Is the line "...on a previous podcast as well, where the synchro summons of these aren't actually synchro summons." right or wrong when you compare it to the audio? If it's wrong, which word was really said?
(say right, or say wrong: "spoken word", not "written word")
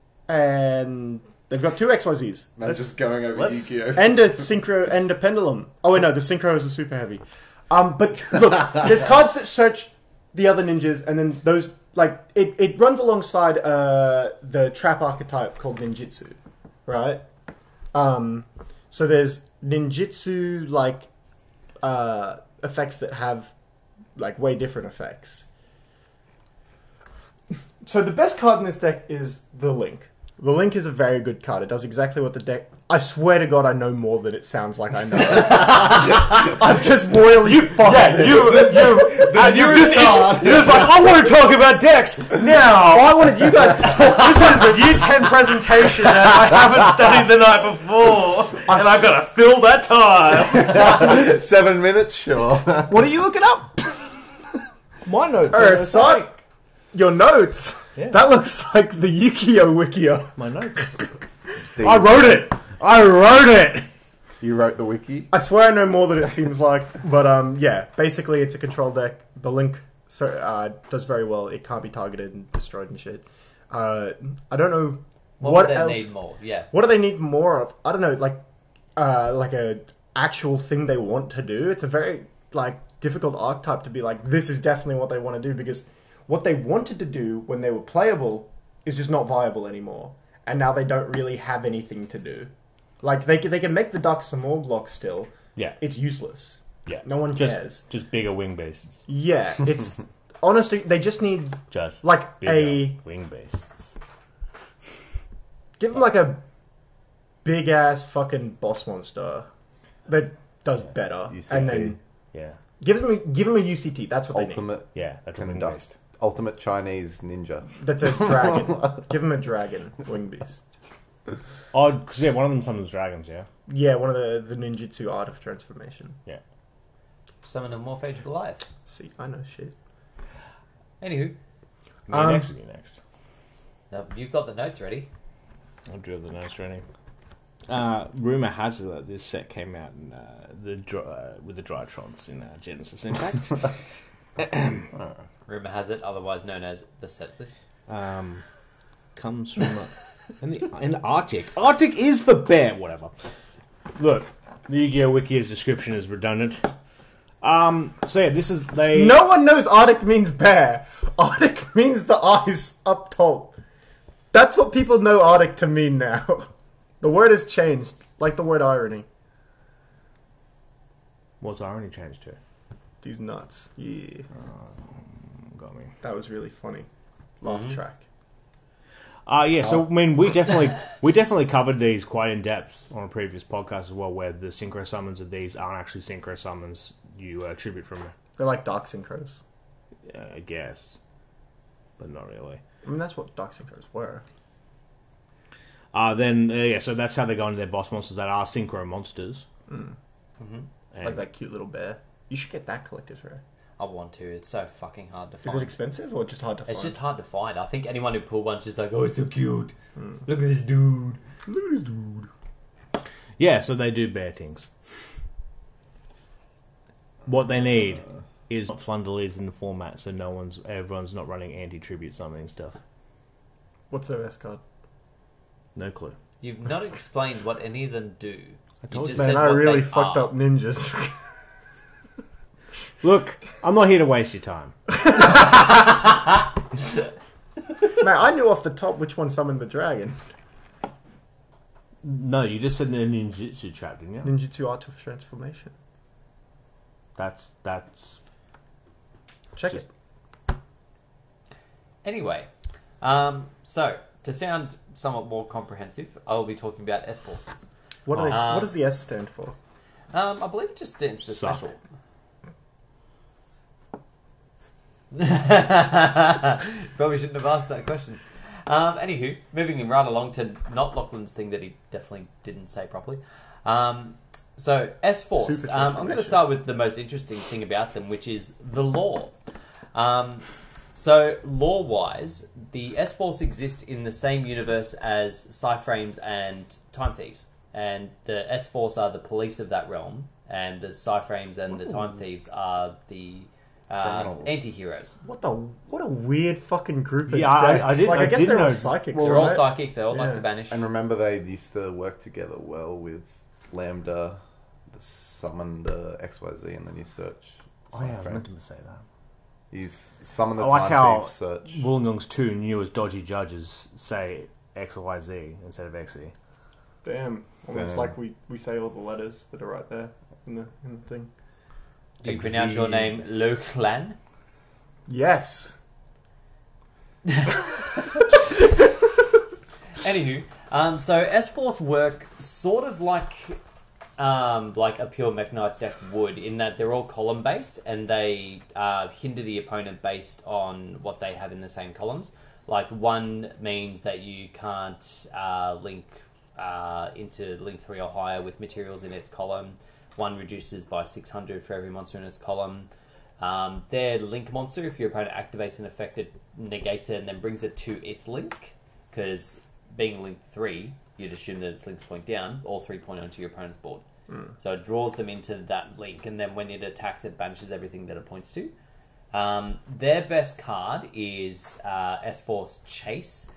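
right.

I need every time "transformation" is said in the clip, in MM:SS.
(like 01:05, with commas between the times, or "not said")
02:05, 04:05.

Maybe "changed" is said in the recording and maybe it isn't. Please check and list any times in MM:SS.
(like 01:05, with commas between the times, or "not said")
02:47, 02:51.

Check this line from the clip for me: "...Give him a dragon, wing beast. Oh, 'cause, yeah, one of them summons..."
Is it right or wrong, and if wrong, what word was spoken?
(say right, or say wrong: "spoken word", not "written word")
right.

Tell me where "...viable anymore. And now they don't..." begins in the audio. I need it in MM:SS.
01:29.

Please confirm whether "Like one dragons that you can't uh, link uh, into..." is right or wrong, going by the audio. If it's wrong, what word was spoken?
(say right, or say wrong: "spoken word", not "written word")
wrong: "means", not "dragons".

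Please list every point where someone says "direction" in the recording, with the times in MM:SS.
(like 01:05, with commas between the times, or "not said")
not said.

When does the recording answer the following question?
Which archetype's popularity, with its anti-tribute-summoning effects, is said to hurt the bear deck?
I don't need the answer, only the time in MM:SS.
03:38.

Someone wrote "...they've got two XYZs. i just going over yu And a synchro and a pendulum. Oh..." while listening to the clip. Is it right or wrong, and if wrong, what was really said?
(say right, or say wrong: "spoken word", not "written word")
right.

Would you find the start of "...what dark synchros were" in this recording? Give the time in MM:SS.
03:13.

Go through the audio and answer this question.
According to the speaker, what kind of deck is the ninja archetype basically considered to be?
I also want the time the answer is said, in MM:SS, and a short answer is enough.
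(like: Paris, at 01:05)
Control deck, at 01:08.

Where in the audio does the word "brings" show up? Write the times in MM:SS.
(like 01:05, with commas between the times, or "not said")
05:57.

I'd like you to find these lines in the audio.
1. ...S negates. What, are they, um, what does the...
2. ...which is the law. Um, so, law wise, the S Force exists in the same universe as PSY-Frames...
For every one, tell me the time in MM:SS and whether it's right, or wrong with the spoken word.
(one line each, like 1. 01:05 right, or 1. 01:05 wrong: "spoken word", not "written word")
1. 04:17 wrong: "forces", not "negates"
2. 04:38 right.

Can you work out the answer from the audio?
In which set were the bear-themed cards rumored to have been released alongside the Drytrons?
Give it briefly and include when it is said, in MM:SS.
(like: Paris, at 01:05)
Genesis Impact, at 02:22.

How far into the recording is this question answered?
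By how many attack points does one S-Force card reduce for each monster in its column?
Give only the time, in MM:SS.
05:51.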